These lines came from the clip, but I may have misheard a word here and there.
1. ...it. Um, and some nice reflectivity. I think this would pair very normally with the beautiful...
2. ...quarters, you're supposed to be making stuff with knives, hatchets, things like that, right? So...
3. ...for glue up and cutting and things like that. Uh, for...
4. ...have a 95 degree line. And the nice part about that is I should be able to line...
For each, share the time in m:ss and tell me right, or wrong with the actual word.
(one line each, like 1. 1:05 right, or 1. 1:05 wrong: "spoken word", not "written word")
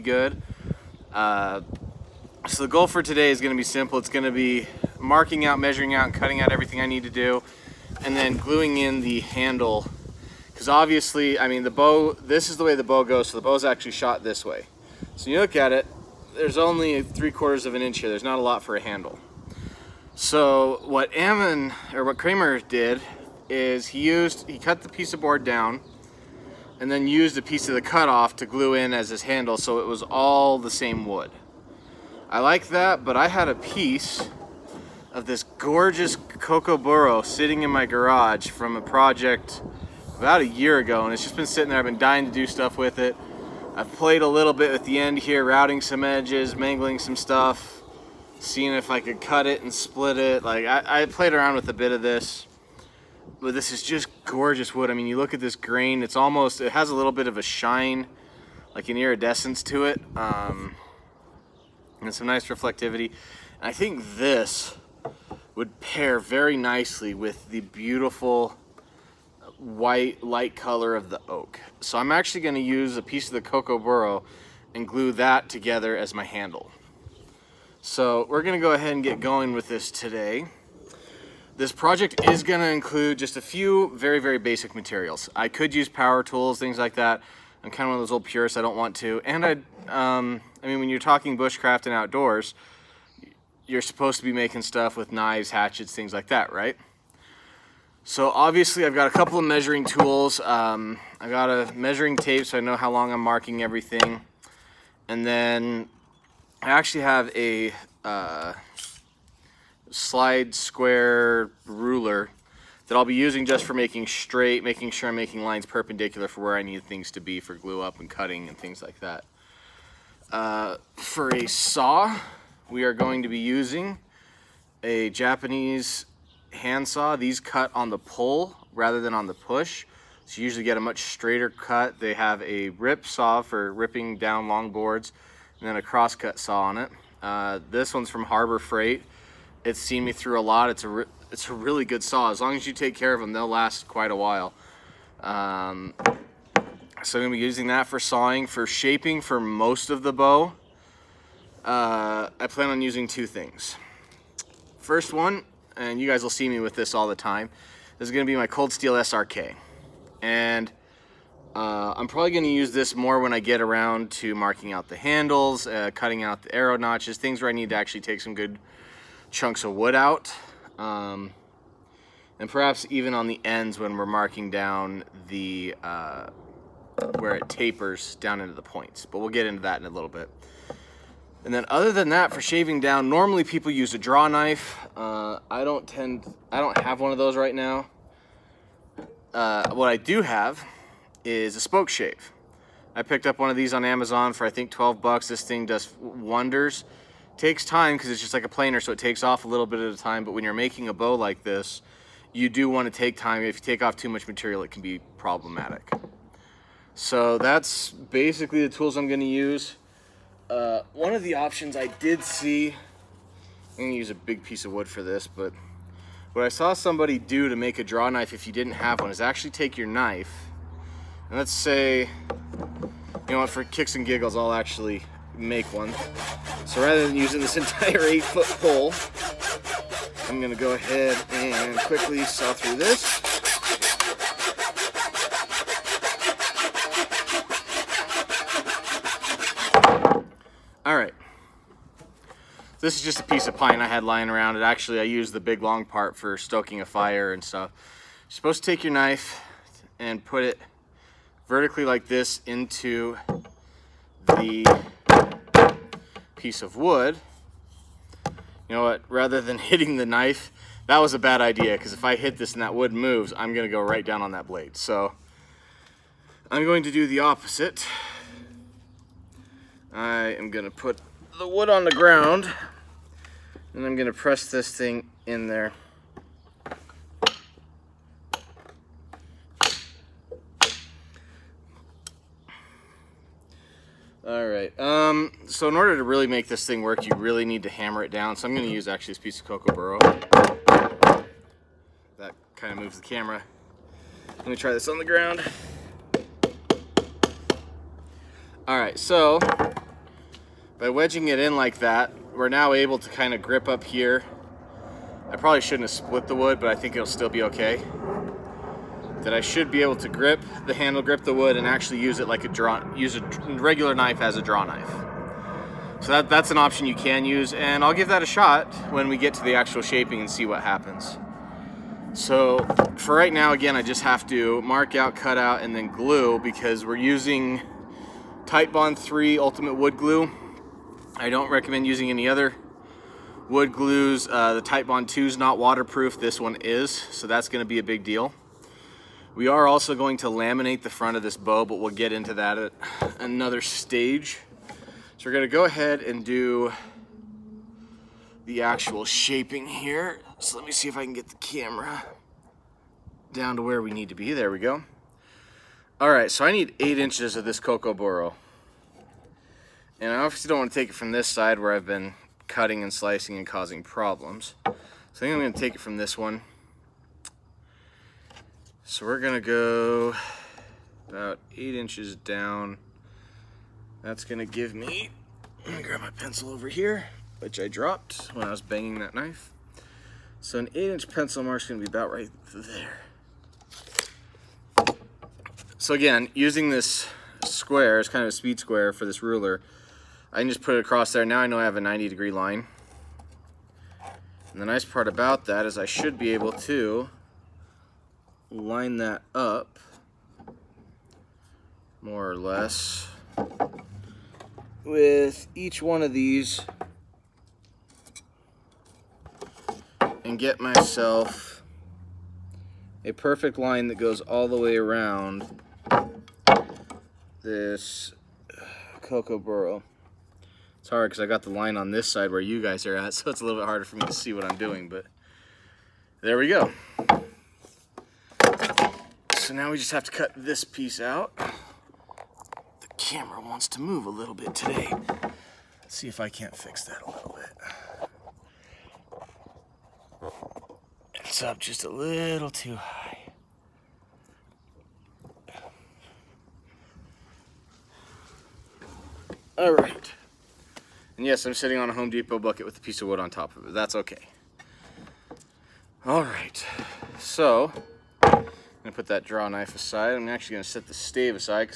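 1. 0:59 wrong: "nicely", not "normally"
2. 1:31 wrong: "outdoors", not "quarters"
3. 1:57 right
4. 6:31 wrong: "90", not "95".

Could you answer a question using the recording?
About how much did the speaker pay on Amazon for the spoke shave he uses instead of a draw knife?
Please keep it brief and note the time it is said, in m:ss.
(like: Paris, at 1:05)
12 bucks, at 3:14.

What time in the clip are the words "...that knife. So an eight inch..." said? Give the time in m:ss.
6:18.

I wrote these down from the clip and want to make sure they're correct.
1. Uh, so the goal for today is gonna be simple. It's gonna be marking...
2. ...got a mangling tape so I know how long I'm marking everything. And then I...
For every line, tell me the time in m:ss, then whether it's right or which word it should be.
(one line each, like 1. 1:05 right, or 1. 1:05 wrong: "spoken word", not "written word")
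1. 0:01 right
2. 1:41 wrong: "measuring", not "mangling".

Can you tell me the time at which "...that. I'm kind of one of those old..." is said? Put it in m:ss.
1:26.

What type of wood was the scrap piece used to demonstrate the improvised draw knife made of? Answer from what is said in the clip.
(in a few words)
pine.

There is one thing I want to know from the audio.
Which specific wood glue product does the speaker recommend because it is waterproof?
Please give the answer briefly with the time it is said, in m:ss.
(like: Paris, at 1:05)
Titebond 3 Ultimate Wood Glue, at 5:28.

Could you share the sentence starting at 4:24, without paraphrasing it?
So I'm going to do the opposite.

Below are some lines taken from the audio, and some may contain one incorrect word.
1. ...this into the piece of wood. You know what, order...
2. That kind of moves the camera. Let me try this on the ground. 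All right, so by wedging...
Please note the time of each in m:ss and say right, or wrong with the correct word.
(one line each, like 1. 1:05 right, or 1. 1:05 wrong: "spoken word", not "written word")
1. 4:12 wrong: "rather", not "order"
2. 4:52 right.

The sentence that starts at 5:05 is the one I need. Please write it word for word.
I probably shouldn't have split the wood, but I think it'll still be okay.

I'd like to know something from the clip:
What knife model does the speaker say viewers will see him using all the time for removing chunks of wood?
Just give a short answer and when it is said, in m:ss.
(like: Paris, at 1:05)
Cold Steel SRK, at 2:38.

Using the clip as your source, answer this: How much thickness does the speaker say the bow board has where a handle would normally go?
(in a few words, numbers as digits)
three quarters of an inch.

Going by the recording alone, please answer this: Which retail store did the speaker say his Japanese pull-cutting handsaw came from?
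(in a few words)
Harbor Freight.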